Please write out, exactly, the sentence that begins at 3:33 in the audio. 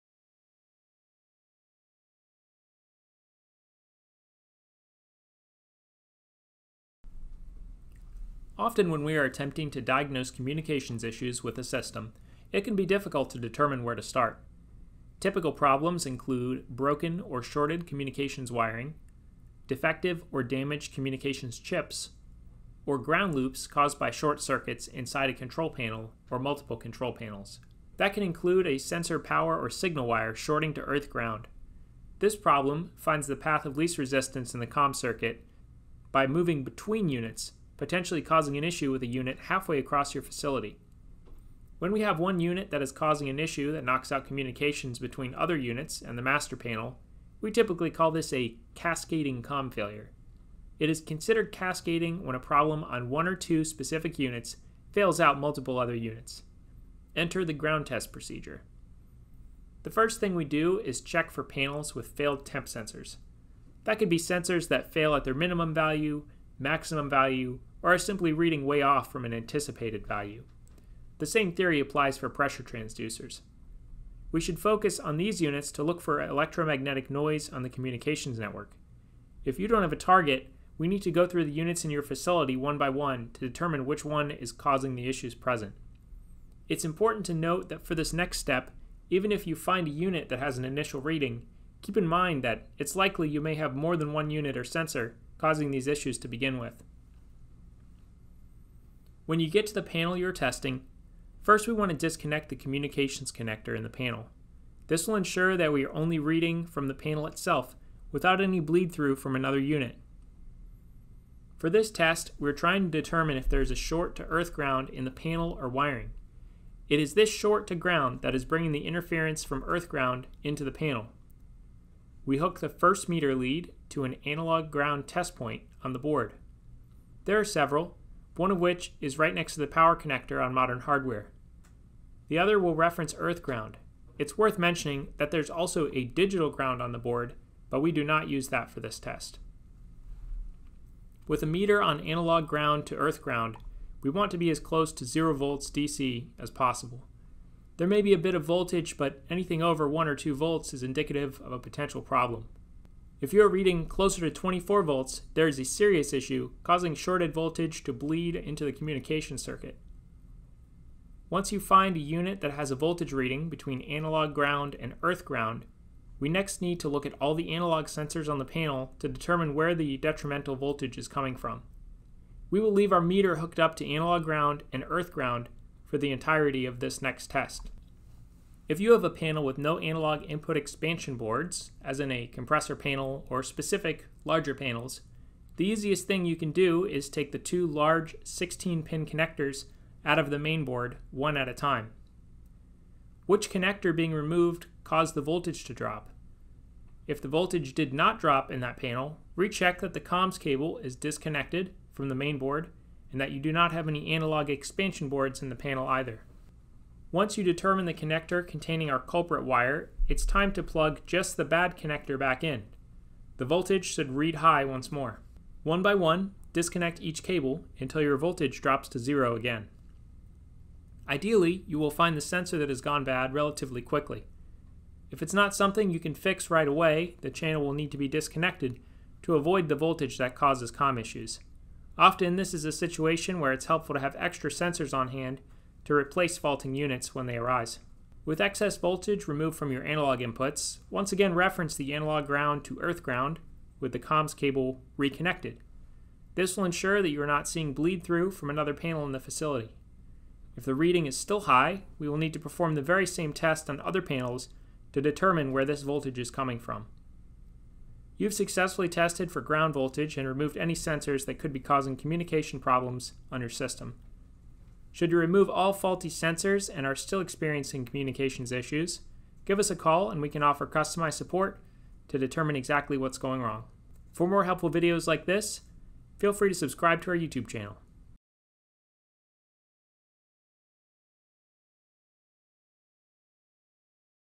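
The voltage should read high once more.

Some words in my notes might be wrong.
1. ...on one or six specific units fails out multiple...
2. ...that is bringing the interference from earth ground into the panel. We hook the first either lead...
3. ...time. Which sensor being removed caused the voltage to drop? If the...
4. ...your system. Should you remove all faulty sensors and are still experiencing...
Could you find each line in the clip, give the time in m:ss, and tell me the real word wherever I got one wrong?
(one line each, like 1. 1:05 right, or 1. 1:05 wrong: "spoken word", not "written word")
1. 0:52 wrong: "two", not "six"
2. 1:58 wrong: "meter", not "either"
3. 3:11 wrong: "connector", not "sensor"
4. 4:23 right.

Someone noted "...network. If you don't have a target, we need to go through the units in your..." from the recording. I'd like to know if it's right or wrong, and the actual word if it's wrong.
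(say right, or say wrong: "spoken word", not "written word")
right.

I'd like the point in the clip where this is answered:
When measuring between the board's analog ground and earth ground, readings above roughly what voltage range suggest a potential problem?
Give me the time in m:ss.
2:29.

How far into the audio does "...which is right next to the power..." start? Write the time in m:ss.
2:08.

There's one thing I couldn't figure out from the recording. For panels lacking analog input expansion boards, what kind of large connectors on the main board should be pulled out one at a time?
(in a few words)
16-pin connectors.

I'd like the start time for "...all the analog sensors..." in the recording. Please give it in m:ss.
2:47.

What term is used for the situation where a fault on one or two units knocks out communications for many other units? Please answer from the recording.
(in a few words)
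Cascading COM failure.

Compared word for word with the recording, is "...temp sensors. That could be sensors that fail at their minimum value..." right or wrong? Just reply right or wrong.
right.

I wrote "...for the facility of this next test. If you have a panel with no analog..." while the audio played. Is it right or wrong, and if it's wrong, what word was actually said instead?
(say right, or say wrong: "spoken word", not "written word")
wrong: "entirety", not "facility".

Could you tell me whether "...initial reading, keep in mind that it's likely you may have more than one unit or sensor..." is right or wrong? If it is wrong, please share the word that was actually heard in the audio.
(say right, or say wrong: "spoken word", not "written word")
right.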